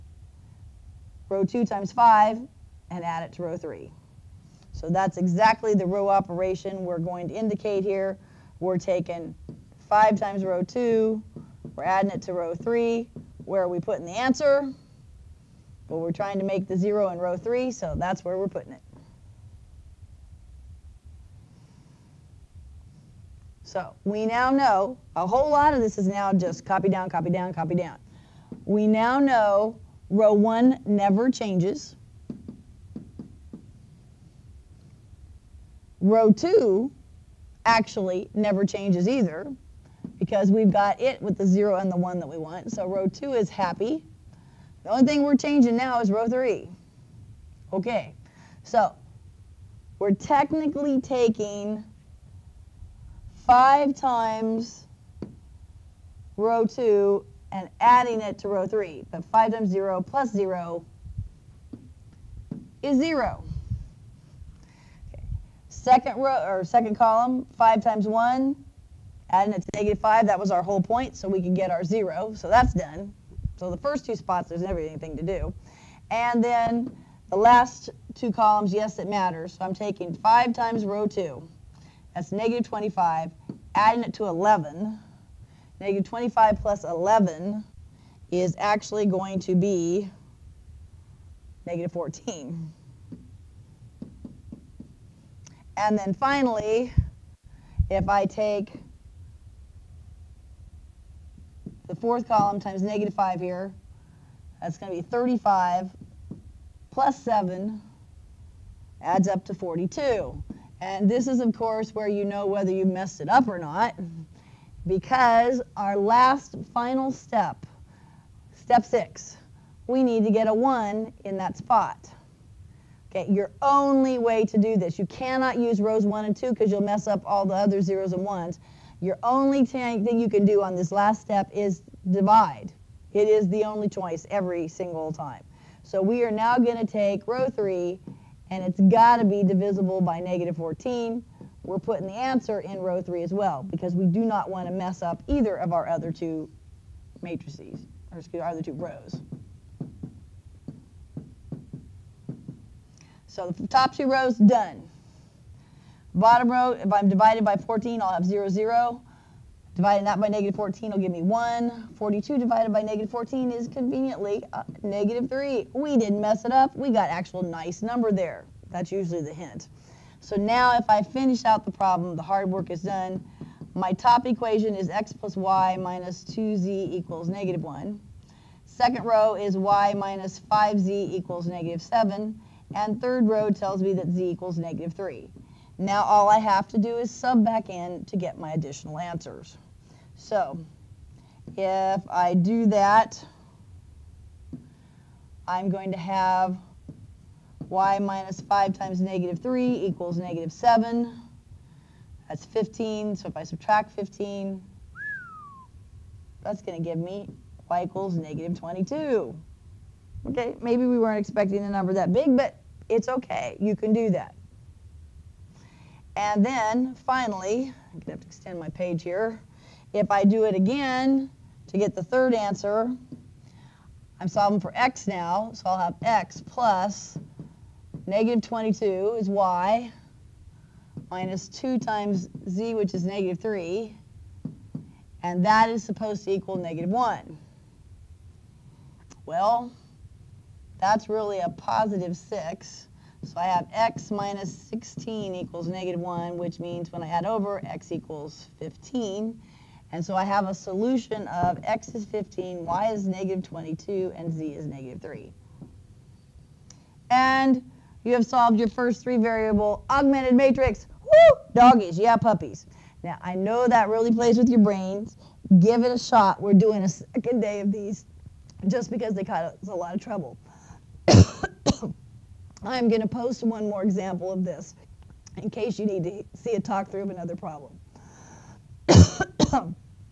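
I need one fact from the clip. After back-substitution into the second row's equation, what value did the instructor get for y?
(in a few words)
-22.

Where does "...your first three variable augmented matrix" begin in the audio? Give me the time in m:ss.
4:18.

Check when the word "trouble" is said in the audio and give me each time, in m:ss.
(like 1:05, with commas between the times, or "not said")
4:29.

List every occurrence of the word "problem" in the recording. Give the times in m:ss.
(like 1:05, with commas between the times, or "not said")
2:51, 4:37.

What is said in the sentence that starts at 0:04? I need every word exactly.
So that's exactly the row operation we're going to indicate here.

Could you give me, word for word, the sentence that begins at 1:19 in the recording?
So I'm taking 5 times row 2.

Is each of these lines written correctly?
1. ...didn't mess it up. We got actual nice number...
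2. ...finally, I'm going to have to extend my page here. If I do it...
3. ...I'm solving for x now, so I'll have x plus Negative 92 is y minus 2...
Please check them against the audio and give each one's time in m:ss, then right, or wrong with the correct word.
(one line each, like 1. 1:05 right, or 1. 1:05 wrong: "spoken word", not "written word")
1. 2:45 right
2. 3:36 right
3. 3:44 wrong: "22", not "92".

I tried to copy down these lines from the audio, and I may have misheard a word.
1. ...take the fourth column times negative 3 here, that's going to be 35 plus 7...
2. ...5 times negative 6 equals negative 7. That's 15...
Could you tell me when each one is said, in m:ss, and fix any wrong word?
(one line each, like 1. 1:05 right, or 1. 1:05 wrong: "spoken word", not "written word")
1. 1:38 wrong: "5", not "3"
2. 3:18 wrong: "3", not "6".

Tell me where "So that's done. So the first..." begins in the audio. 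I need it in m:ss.
1:12.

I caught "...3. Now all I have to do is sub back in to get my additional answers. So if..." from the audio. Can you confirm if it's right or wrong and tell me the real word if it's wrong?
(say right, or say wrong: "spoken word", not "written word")
right.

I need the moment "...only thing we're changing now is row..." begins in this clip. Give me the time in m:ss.
0:44.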